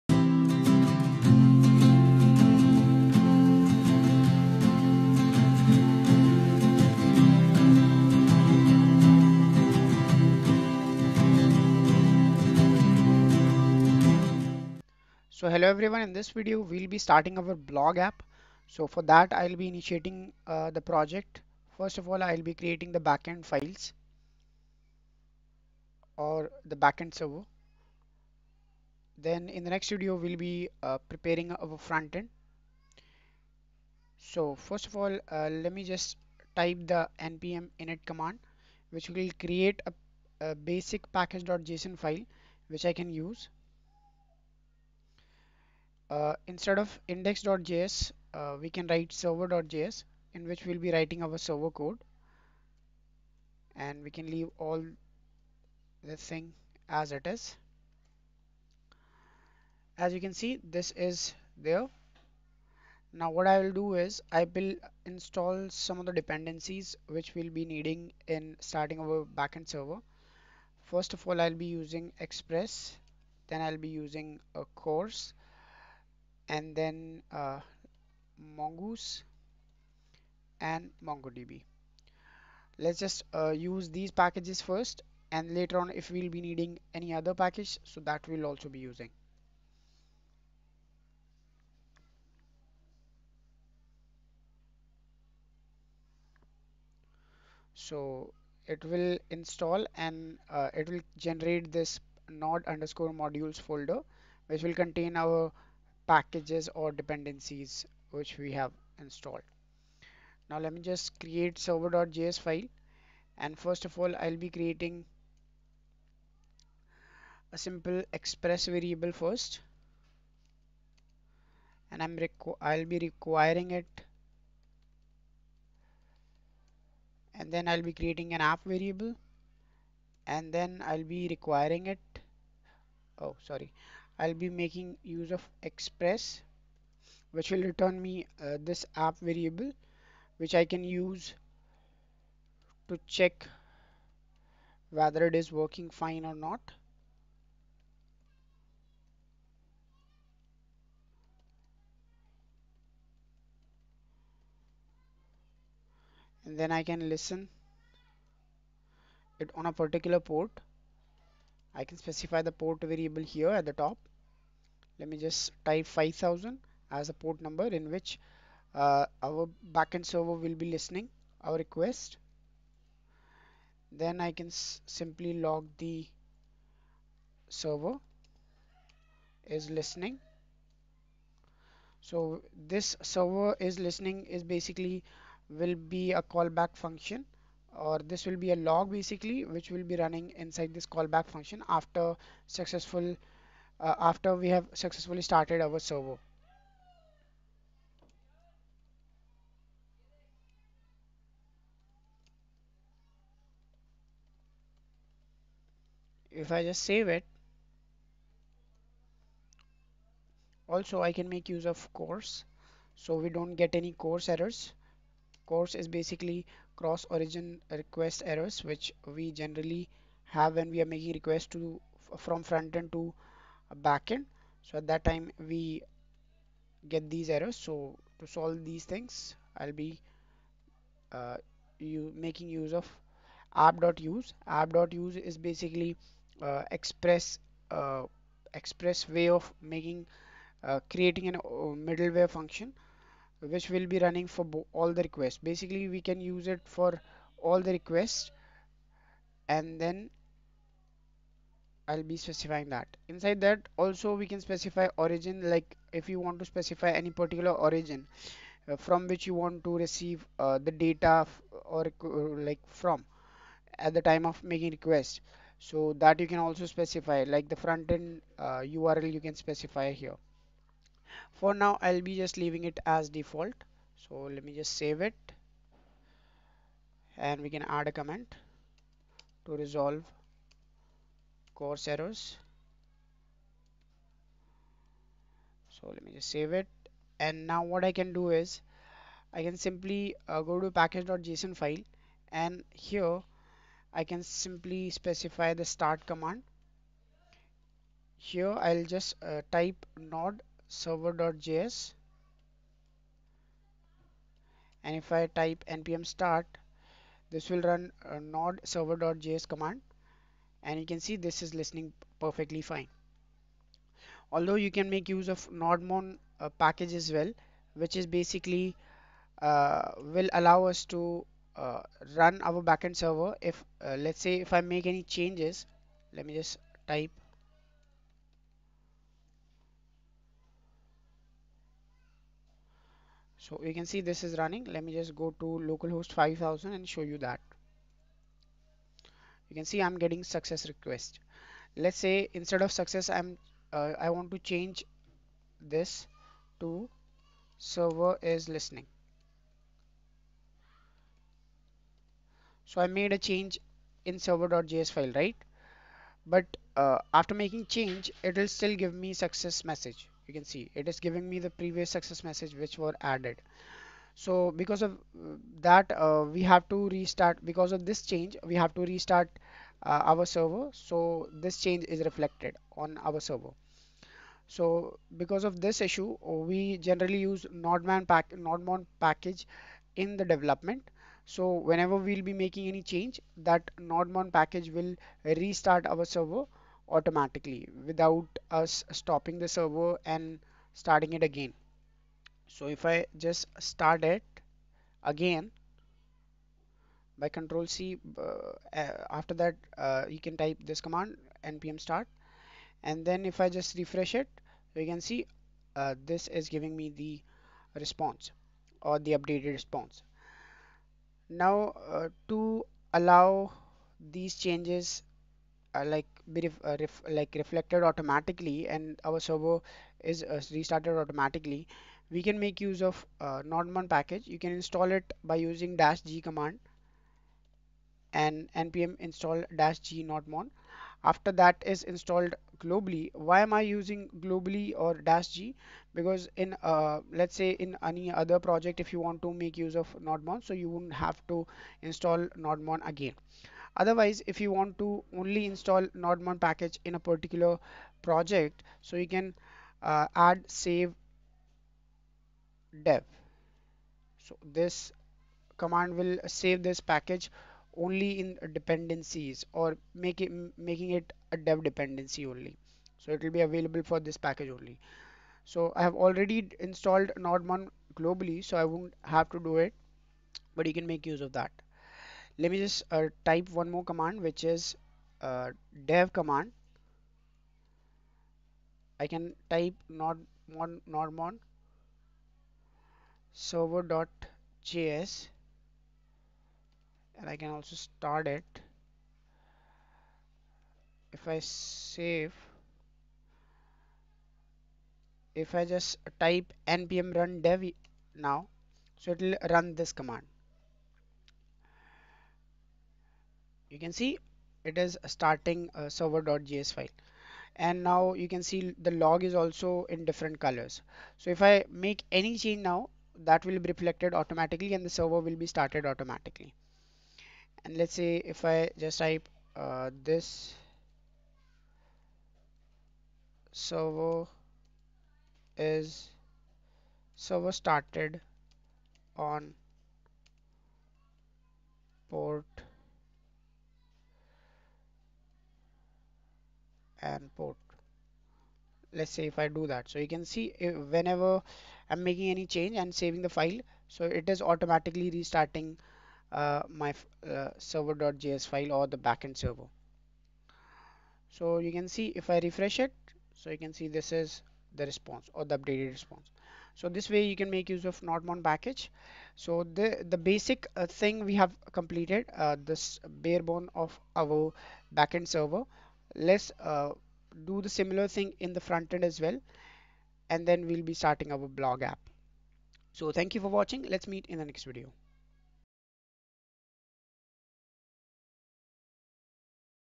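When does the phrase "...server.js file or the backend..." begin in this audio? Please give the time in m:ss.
9:07.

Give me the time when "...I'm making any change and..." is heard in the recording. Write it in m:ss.
9:01.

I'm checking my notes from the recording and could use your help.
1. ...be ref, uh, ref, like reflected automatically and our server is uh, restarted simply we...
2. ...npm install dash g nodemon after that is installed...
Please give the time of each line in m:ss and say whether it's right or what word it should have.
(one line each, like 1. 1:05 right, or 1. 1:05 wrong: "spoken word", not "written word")
1. 6:56 wrong: "automatically", not "simply"
2. 7:08 right.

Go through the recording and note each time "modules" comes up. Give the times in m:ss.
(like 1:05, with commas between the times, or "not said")
1:43.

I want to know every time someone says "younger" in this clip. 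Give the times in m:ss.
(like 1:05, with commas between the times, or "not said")
not said.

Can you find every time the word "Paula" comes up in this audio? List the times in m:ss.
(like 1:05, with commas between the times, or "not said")
not said.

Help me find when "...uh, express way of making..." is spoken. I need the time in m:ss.
3:57.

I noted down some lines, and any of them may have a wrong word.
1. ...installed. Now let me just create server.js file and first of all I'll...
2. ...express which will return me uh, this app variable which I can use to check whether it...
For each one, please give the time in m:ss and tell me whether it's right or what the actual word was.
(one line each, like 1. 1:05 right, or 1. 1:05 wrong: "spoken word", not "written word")
1. 1:48 right
2. 2:15 right.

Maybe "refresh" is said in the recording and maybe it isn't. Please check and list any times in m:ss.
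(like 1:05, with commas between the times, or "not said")
6:43, 9:12.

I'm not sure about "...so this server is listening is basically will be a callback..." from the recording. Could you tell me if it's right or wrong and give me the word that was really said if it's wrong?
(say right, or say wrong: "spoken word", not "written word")
right.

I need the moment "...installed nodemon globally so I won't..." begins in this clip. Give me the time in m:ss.
7:46.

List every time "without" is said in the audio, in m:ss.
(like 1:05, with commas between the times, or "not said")
6:27.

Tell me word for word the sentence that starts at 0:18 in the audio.
So for that I'll be initiating uh, the project.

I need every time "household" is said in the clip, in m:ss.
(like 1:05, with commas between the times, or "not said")
not said.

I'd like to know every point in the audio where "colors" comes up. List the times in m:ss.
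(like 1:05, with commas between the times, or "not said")
8:30.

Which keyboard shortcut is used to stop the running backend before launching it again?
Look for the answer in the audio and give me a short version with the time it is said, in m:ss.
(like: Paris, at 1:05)
control C, at 6:37.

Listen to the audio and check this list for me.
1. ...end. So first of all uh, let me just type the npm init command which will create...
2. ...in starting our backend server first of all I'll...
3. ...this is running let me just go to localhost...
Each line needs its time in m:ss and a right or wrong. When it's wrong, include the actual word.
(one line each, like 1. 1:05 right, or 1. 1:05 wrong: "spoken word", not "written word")
1. 0:32 right
2. 1:08 right
3. 5:33 right.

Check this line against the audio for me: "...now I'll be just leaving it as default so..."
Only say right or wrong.
right.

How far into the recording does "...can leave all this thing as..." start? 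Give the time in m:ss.
0:54.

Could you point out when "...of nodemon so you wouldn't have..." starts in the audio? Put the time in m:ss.
7:19.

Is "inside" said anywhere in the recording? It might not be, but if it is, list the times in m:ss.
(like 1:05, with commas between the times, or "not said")
3:10, 4:13.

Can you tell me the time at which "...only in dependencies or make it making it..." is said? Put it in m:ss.
7:37.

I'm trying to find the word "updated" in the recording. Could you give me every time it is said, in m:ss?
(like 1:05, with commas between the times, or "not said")
6:49, 9:15.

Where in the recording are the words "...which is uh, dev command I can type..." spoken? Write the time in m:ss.
7:54.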